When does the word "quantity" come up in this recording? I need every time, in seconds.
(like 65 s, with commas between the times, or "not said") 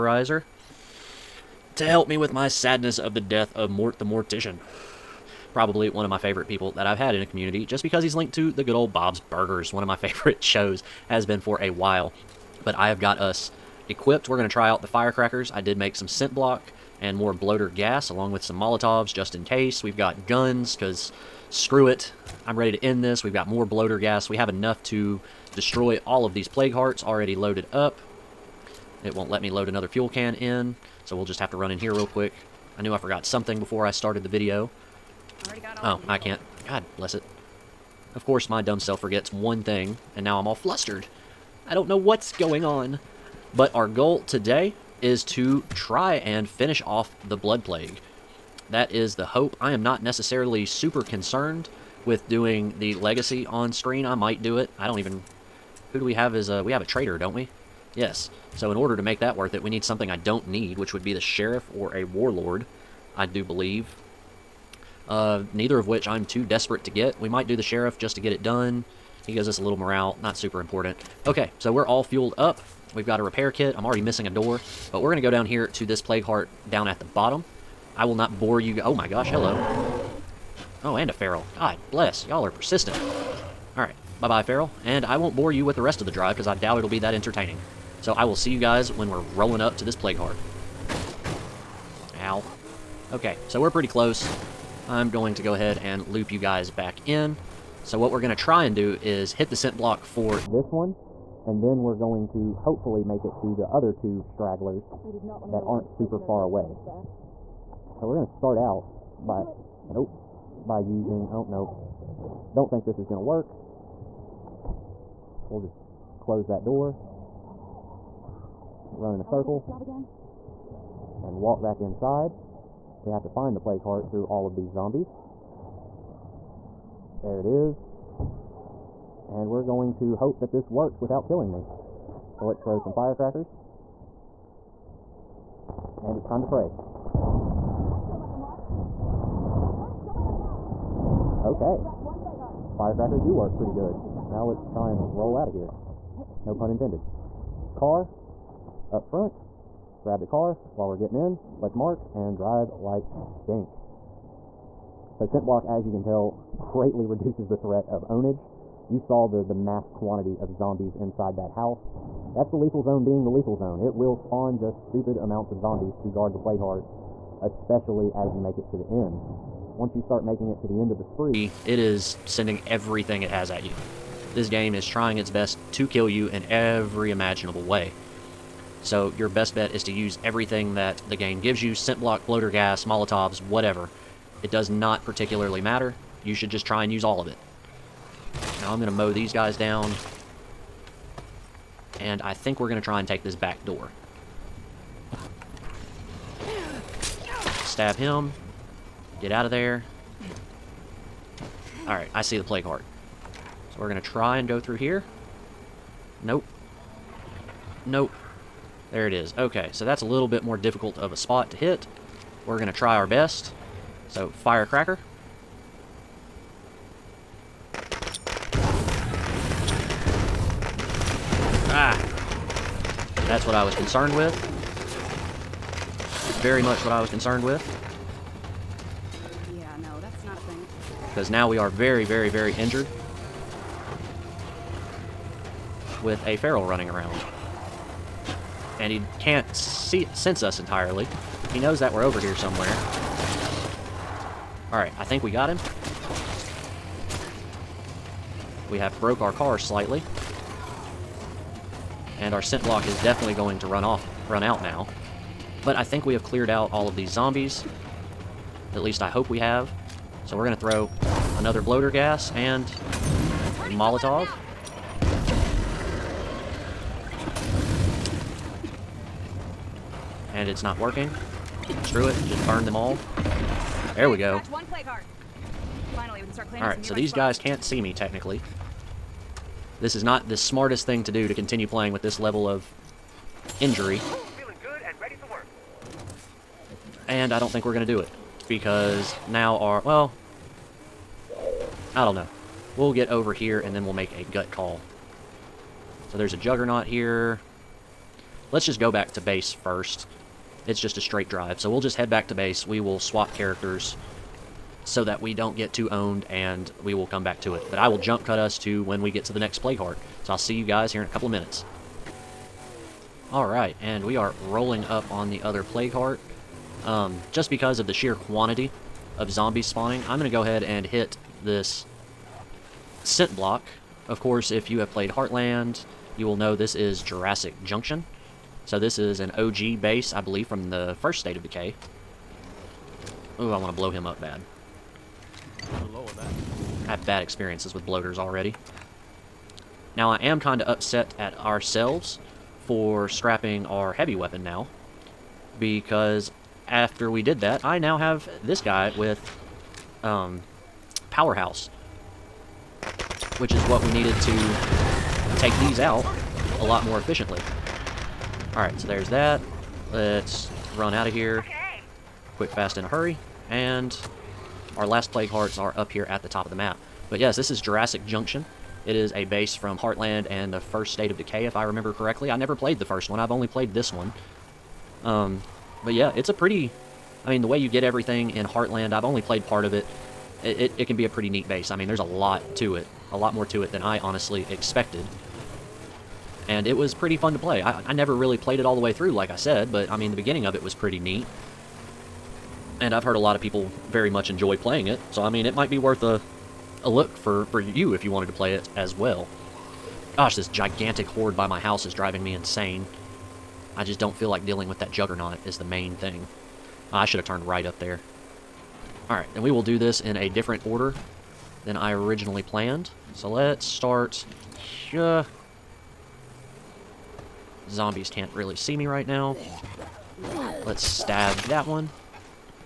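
159 s, 318 s.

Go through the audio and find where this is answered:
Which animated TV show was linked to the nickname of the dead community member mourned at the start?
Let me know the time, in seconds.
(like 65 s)
8 s.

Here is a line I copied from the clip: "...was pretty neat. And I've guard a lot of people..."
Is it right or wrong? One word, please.
wrong.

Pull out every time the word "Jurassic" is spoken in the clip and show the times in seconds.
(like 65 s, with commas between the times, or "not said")
327 s, 367 s.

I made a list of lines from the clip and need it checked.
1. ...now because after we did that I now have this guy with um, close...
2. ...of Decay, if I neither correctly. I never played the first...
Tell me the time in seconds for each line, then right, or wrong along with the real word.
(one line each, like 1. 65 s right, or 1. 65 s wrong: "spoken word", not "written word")
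1. 344 s wrong: "powerhouse", not "close"
2. 371 s wrong: "remember", not "neither".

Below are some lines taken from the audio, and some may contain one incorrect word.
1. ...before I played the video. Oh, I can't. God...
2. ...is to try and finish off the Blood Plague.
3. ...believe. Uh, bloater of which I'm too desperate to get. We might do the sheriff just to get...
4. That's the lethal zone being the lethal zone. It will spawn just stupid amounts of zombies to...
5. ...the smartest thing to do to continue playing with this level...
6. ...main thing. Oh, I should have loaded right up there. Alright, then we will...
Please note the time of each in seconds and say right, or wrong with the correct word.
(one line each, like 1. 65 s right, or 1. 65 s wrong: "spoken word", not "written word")
1. 33 s wrong: "started", not "played"
2. 45 s right
3. 63 s wrong: "neither", not "bloater"
4. 162 s right
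5. 280 s right
6. 405 s wrong: "turned", not "loaded".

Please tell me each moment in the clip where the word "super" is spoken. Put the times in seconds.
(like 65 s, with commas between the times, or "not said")
50 s, 70 s, 105 s.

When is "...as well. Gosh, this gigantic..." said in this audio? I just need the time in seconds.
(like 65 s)
398 s.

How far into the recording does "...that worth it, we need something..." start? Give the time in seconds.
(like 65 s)
59 s.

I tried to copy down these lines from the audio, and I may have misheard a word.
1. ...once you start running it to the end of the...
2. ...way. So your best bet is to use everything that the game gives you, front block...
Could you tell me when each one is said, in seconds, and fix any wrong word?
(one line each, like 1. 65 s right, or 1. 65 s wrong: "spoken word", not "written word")
1. 169 s wrong: "making", not "running"
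2. 177 s wrong: "scent", not "front".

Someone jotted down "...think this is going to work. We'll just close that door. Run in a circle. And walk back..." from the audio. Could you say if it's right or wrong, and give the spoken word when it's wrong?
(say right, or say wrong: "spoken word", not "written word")
right.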